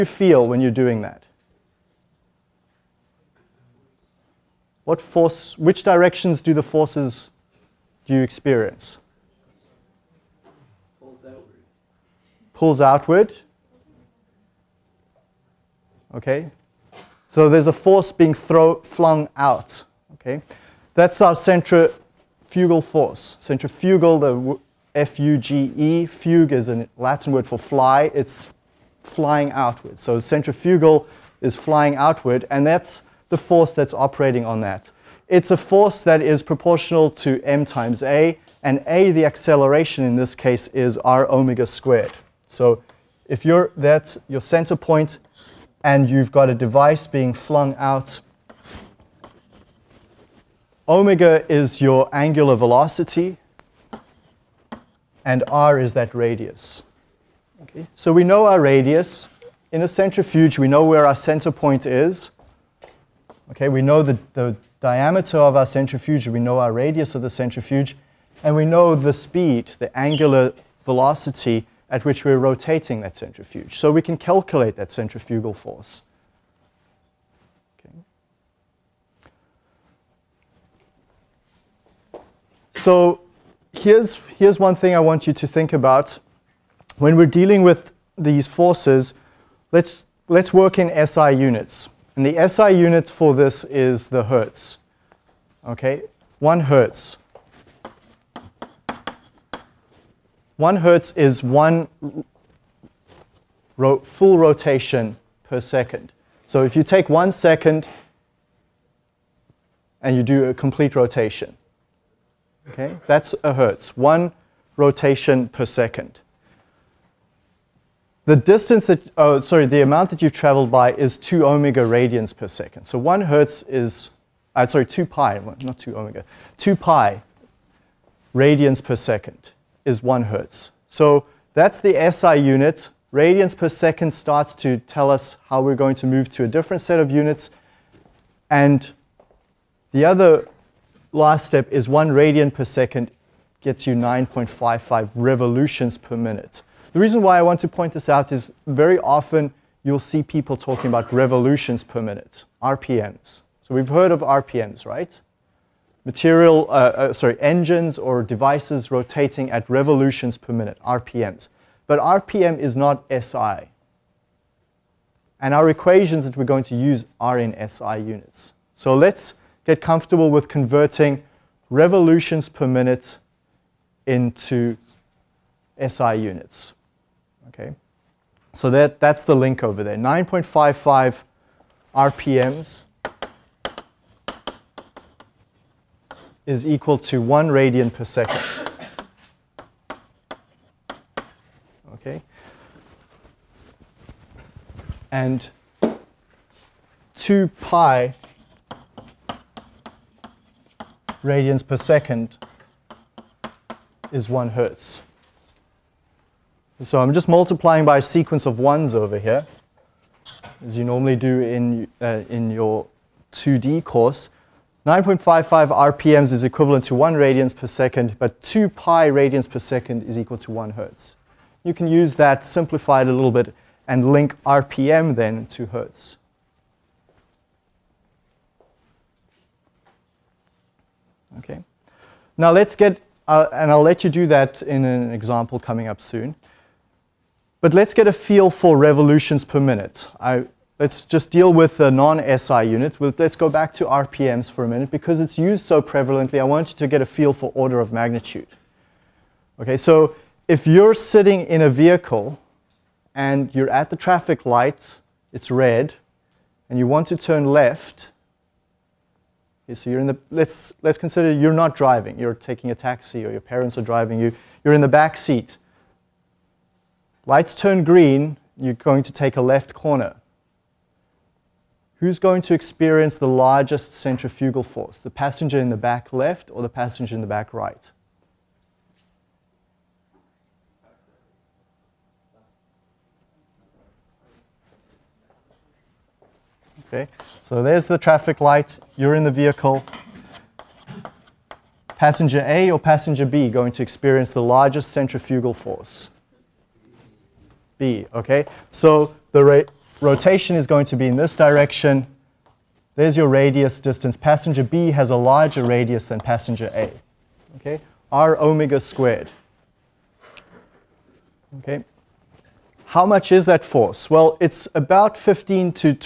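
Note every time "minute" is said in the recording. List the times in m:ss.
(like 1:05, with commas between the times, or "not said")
2:26, 2:32, 2:40, 2:52, 3:59, 4:04.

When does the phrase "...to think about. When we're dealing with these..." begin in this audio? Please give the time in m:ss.
1:25.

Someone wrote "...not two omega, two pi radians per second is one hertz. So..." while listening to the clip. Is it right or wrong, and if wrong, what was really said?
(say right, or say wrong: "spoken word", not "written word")
right.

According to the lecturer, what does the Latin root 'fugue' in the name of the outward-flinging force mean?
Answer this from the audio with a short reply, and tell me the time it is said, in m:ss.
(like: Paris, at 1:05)
fly, at 0:26.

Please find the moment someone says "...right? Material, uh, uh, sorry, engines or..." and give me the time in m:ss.
2:34.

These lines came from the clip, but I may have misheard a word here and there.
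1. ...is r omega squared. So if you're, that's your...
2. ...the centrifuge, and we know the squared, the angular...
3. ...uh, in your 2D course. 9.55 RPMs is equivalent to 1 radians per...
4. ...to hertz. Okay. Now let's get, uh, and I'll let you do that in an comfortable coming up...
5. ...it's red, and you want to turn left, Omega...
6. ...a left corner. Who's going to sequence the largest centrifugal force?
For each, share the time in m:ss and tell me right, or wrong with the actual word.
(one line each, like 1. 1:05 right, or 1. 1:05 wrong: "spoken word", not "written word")
1. 0:40 right
2. 1:07 wrong: "speed", not "squared"
3. 3:32 right
4. 3:45 wrong: "example", not "comfortable"
5. 4:15 wrong: "Okay", not "Omega"
6. 4:29 wrong: "experience", not "sequence".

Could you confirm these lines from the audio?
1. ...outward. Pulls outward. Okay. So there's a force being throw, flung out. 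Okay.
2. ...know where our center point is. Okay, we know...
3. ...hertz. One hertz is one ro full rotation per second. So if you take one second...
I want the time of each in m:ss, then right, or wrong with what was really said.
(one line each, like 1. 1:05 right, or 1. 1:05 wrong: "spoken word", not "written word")
1. 0:11 right
2. 1:00 right
3. 1:36 right.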